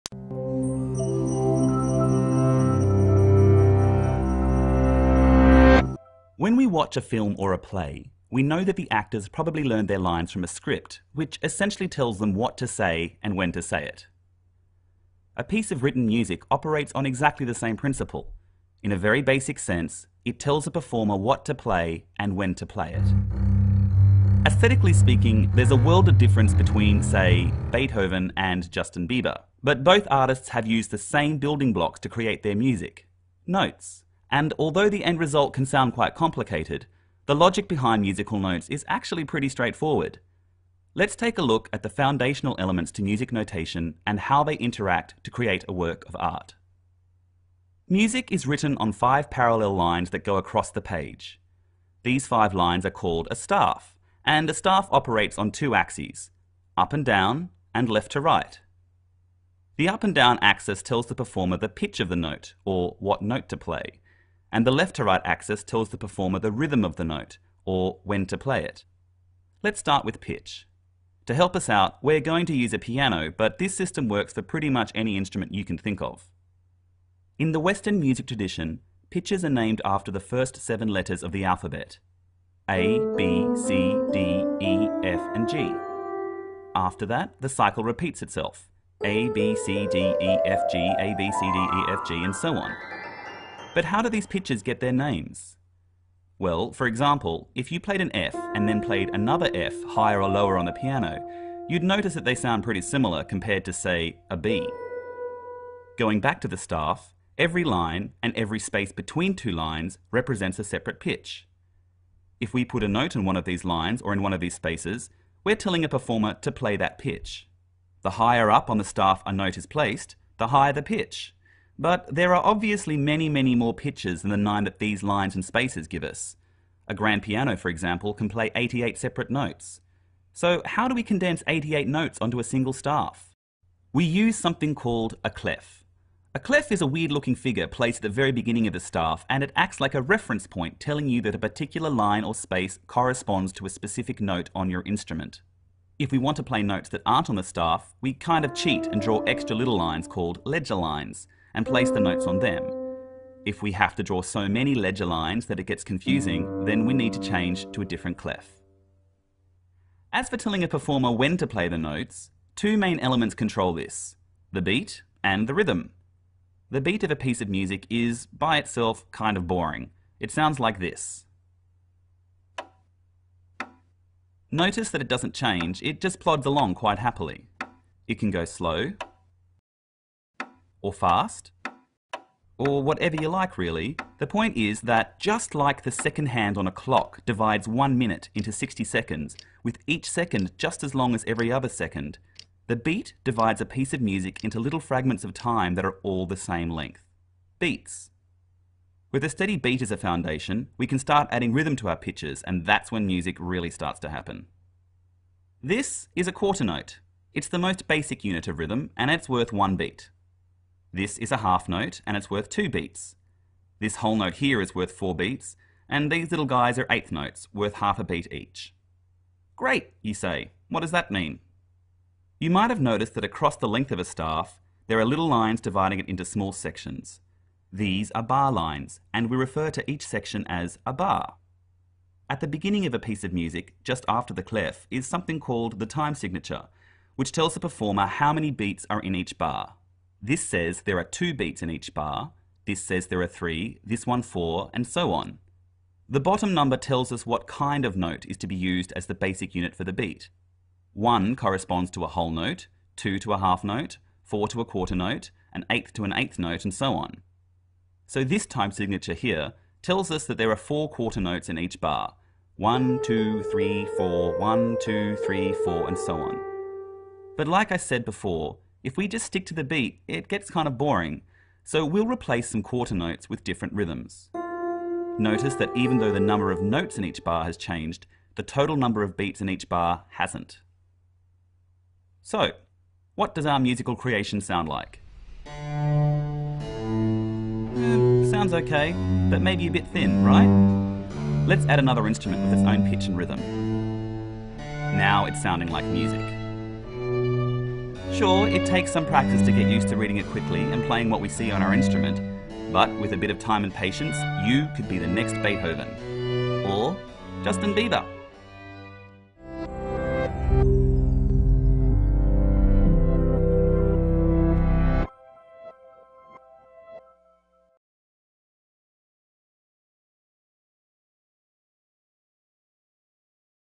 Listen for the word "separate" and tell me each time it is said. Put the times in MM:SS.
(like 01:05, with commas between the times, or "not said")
01:50, 02:08.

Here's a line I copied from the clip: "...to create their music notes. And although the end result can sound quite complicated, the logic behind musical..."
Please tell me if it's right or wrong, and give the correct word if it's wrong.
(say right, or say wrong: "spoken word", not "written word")
right.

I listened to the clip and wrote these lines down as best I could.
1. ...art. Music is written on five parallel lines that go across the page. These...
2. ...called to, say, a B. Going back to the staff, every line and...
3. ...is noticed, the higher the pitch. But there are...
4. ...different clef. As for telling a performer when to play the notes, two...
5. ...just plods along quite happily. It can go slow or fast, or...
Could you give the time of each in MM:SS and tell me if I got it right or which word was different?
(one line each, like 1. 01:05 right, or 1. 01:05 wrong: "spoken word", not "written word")
1. 00:46 right
2. 01:43 wrong: "compared", not "called"
3. 01:59 wrong: "placed", not "noticed"
4. 02:37 right
5. 02:56 right.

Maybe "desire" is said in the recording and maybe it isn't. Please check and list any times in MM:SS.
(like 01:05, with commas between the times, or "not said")
not said.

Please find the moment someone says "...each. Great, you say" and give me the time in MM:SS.
03:38.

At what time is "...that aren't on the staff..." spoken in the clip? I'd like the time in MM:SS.
02:26.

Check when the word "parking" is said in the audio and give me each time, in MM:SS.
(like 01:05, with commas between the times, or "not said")
not said.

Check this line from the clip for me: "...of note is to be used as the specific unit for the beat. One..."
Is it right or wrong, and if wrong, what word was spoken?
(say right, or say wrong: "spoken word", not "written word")
wrong: "basic", not "specific".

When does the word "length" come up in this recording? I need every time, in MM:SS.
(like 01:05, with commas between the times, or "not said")
03:16, 03:43.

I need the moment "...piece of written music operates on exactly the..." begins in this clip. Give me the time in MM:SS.
00:15.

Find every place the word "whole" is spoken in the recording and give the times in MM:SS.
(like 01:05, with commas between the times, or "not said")
03:33, 04:12.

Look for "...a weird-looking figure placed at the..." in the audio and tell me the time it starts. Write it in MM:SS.
02:16.